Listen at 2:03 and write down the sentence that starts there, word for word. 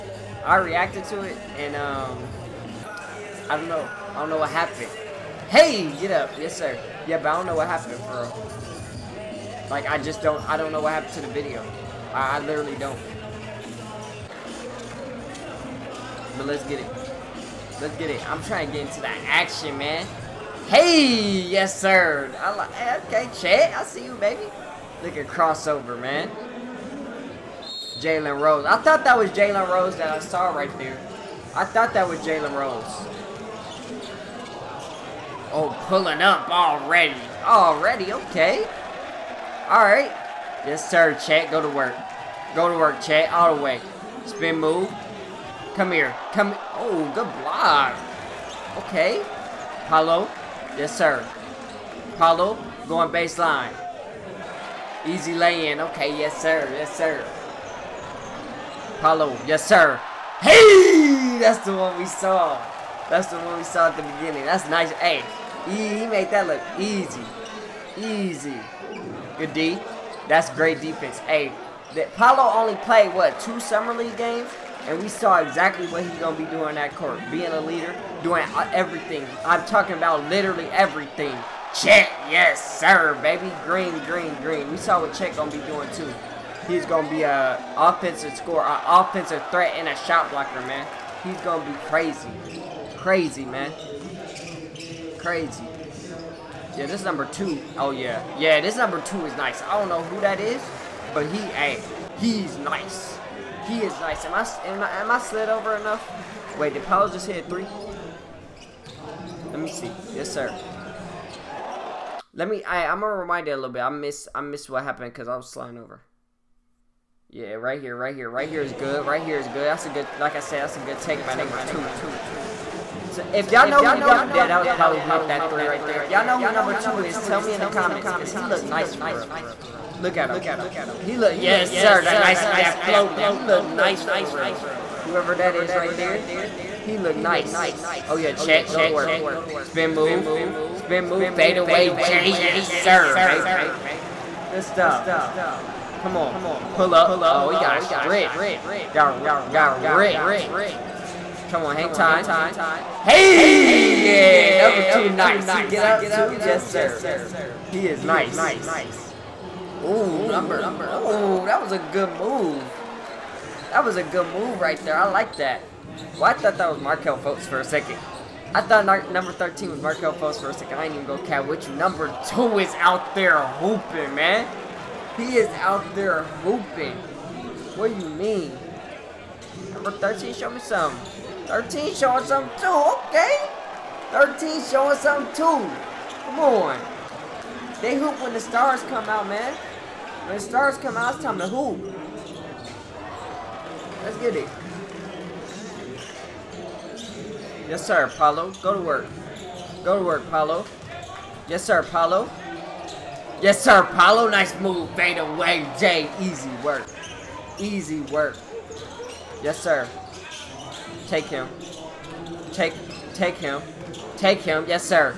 So if y'all know who y'all, yeah, that was probably with that three right there.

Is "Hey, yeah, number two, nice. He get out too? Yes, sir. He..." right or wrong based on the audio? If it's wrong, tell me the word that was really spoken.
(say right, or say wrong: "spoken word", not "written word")
right.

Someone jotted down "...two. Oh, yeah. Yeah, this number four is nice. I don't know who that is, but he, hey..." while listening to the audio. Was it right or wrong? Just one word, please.
wrong.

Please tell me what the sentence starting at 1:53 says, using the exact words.
I miss, I miss what happened because I was sliding over.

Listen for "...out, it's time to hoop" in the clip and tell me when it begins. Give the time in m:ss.
3:10.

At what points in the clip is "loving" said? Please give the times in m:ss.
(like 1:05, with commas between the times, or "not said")
not said.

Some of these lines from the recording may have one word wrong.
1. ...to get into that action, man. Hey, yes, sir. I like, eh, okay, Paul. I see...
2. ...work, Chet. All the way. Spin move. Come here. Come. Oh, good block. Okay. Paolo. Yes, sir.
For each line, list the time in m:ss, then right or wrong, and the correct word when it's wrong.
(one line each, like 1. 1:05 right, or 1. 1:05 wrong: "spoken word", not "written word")
1. 0:18 wrong: "Chet", not "Paul"
2. 0:42 right.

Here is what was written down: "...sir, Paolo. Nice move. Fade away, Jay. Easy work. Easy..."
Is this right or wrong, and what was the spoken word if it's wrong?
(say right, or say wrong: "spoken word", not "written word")
right.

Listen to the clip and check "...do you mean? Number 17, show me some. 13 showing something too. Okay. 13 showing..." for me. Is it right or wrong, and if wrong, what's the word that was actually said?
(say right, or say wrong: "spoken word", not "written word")
wrong: "13", not "17".